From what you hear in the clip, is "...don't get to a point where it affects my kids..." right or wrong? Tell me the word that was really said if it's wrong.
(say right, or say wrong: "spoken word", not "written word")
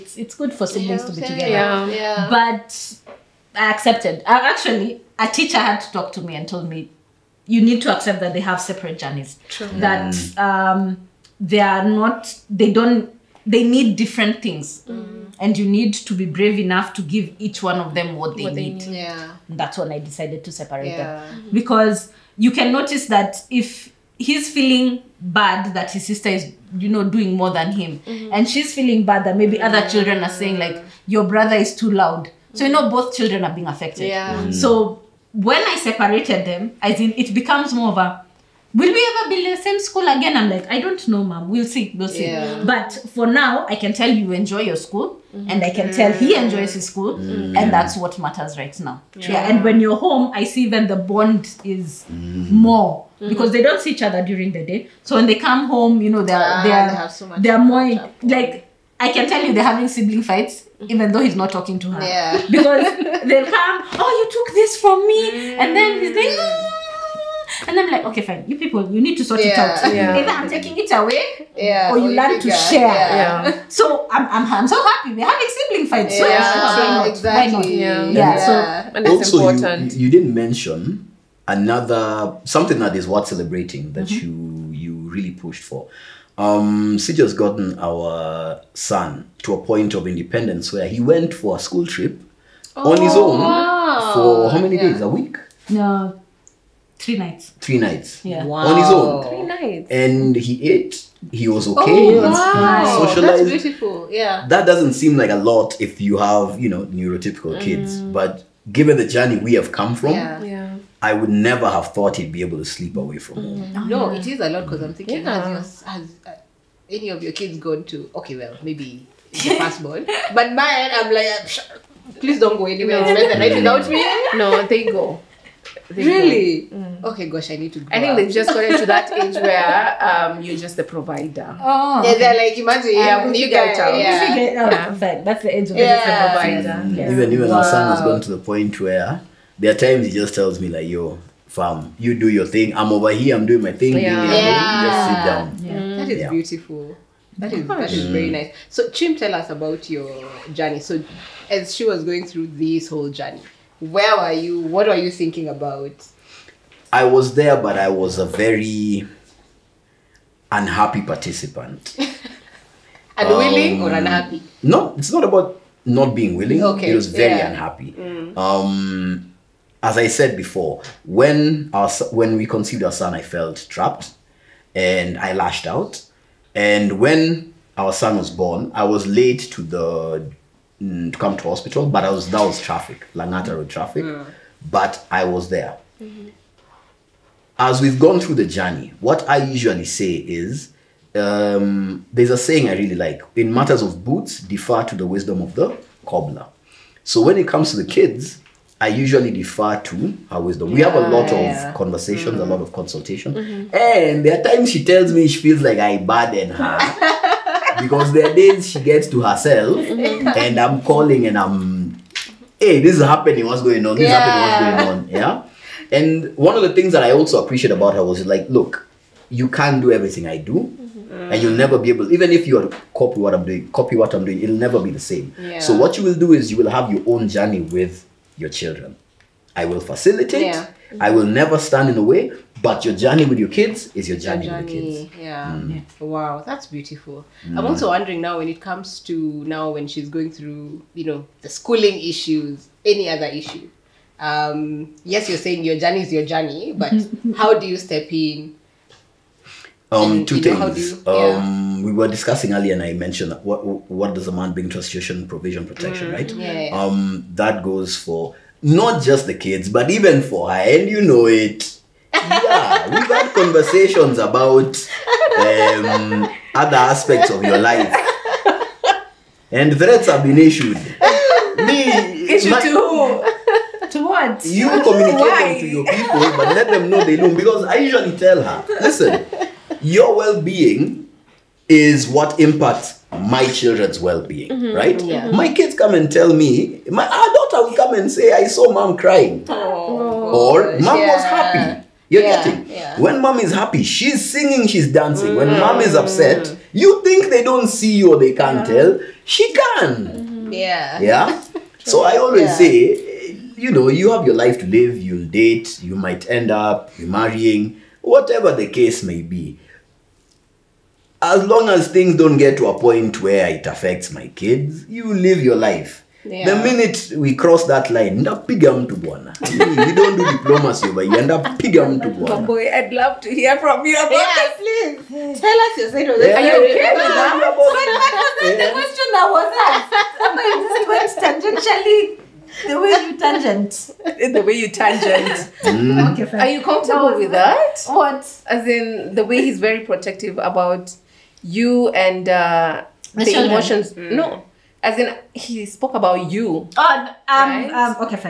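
right.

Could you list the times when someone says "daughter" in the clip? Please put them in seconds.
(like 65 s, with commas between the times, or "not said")
287 s.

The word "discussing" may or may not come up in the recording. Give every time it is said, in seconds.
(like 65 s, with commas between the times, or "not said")
252 s.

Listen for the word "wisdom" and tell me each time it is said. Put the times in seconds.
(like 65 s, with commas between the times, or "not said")
195 s, 200 s.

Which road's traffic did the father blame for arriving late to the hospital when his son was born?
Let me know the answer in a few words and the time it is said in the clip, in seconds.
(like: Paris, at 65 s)
Langata Road, at 183 s.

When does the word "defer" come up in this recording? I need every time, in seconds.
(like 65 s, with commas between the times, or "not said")
194 s, 199 s.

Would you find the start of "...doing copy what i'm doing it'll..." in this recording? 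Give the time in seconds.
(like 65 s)
223 s.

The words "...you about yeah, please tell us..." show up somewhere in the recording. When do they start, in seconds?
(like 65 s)
323 s.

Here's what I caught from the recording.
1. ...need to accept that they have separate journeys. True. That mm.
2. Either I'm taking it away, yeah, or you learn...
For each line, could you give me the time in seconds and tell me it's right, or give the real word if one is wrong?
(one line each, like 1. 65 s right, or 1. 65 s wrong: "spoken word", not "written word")
1. 7 s right
2. 70 s right.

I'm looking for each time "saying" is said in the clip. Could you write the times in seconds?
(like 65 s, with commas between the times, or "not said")
30 s, 192 s, 245 s.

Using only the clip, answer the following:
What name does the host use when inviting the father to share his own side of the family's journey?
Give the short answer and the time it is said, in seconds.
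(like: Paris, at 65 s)
Chim, at 148 s.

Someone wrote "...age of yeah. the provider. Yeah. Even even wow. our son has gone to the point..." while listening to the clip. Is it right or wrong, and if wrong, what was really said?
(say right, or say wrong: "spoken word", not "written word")
right.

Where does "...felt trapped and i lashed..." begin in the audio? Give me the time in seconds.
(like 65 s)
173 s.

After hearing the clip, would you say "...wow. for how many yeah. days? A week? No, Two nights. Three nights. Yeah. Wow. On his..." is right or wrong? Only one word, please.
wrong.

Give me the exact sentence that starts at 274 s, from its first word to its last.
You communicate them to your people, but let them know they know.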